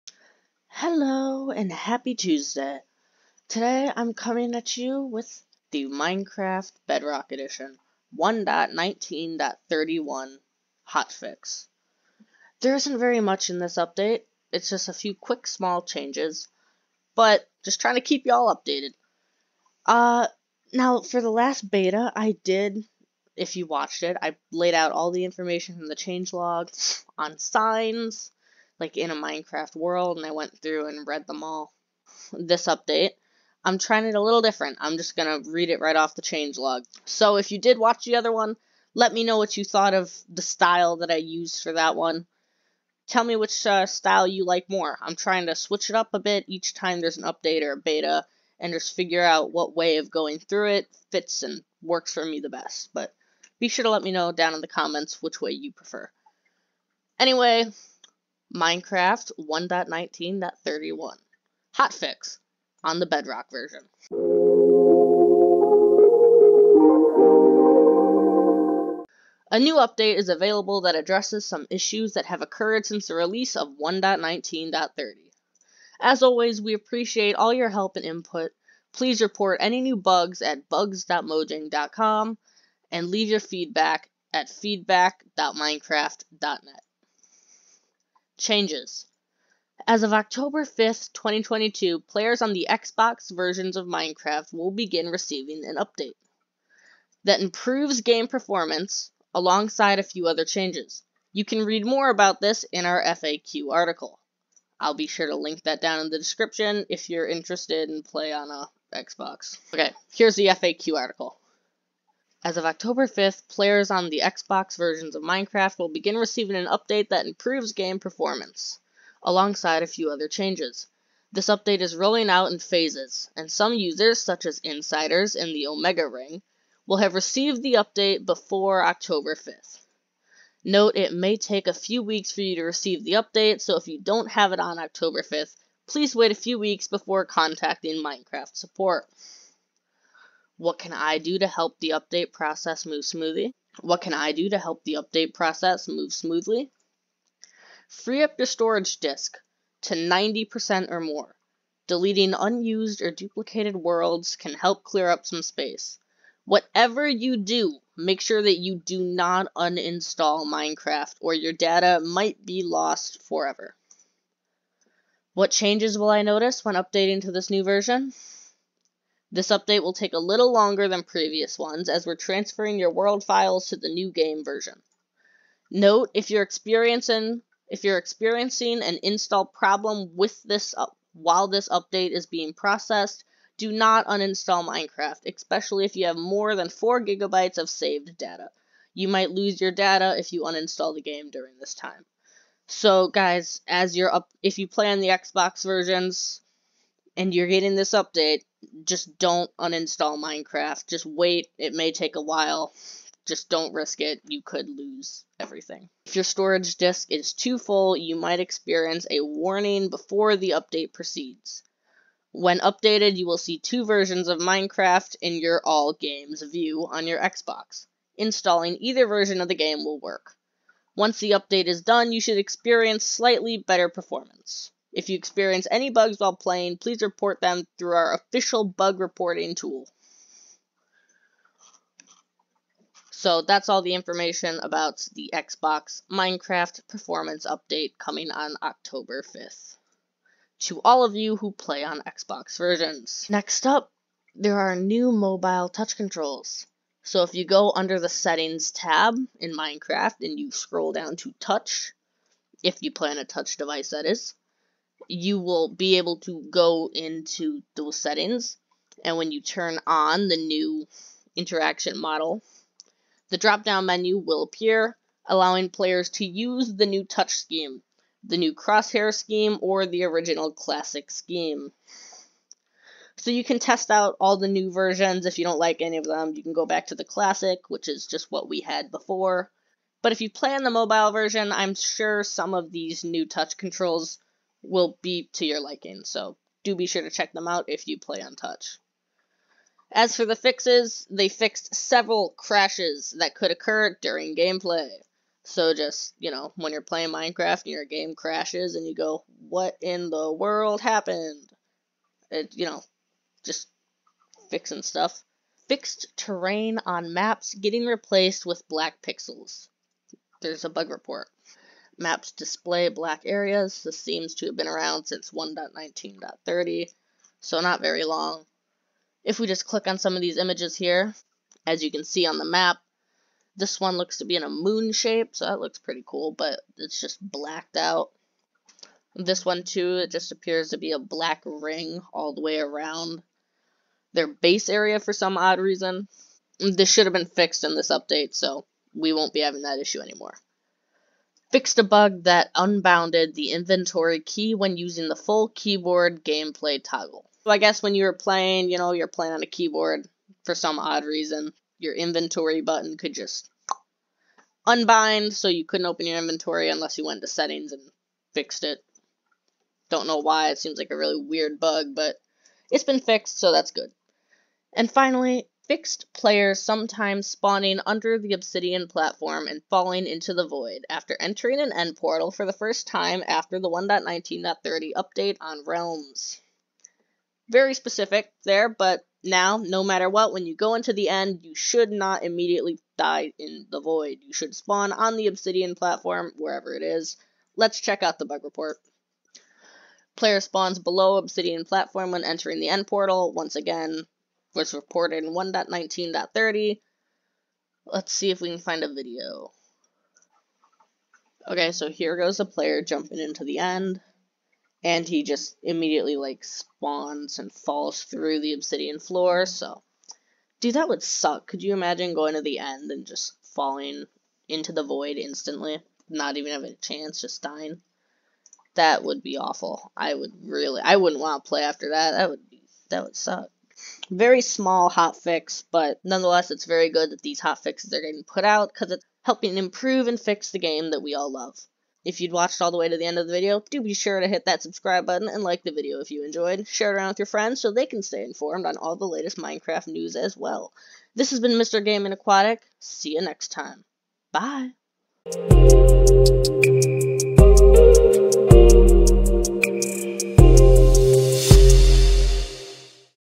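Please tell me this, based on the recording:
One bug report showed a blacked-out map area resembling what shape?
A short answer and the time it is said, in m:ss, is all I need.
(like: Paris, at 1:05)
moon shape, at 5:24.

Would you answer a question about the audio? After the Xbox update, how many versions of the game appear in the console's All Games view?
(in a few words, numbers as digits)
2.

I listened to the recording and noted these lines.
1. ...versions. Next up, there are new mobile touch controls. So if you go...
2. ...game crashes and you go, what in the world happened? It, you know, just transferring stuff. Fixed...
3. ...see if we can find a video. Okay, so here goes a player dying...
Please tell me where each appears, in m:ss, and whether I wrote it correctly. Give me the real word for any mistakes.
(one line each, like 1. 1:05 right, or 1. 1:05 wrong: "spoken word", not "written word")
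1. 4:02 right
2. 4:57 wrong: "fixing", not "transferring"
3. 6:38 wrong: "jumping", not "dying".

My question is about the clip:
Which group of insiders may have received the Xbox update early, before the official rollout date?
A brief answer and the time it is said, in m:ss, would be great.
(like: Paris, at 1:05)
Omega Ring, at 2:05.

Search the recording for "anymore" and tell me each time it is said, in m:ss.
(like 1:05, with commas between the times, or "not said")
5:39.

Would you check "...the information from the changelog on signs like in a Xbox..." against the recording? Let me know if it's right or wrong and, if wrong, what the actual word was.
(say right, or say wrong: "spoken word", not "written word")
wrong: "Minecraft", not "Xbox".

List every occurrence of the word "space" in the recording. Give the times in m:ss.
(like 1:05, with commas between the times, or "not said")
2:35.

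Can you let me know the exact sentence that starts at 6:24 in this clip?
You should spawn on the obsidian platform, wherever it is.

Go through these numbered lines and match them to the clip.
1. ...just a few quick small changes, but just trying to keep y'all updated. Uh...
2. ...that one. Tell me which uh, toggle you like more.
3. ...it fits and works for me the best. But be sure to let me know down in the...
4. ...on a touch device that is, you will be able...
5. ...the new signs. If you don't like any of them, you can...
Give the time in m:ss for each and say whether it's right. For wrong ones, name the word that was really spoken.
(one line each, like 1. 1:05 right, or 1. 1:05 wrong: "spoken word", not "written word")
1. 0:14 right
2. 0:41 wrong: "style", not "toggle"
3. 0:50 right
4. 4:13 right
5. 4:34 wrong: "versions", not "signs".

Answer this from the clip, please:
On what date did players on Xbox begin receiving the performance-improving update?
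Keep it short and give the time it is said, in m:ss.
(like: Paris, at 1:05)
October 5th, 2022, at 1:30.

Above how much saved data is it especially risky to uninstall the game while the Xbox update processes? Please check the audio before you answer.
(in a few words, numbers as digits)
4 gigabytes.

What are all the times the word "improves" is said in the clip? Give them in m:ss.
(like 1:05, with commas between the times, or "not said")
1:37, 1:57, 7:09.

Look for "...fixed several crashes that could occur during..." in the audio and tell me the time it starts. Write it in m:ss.
4:51.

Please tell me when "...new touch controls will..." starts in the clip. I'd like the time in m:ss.
4:43.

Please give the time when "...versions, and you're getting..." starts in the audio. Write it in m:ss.
3:15.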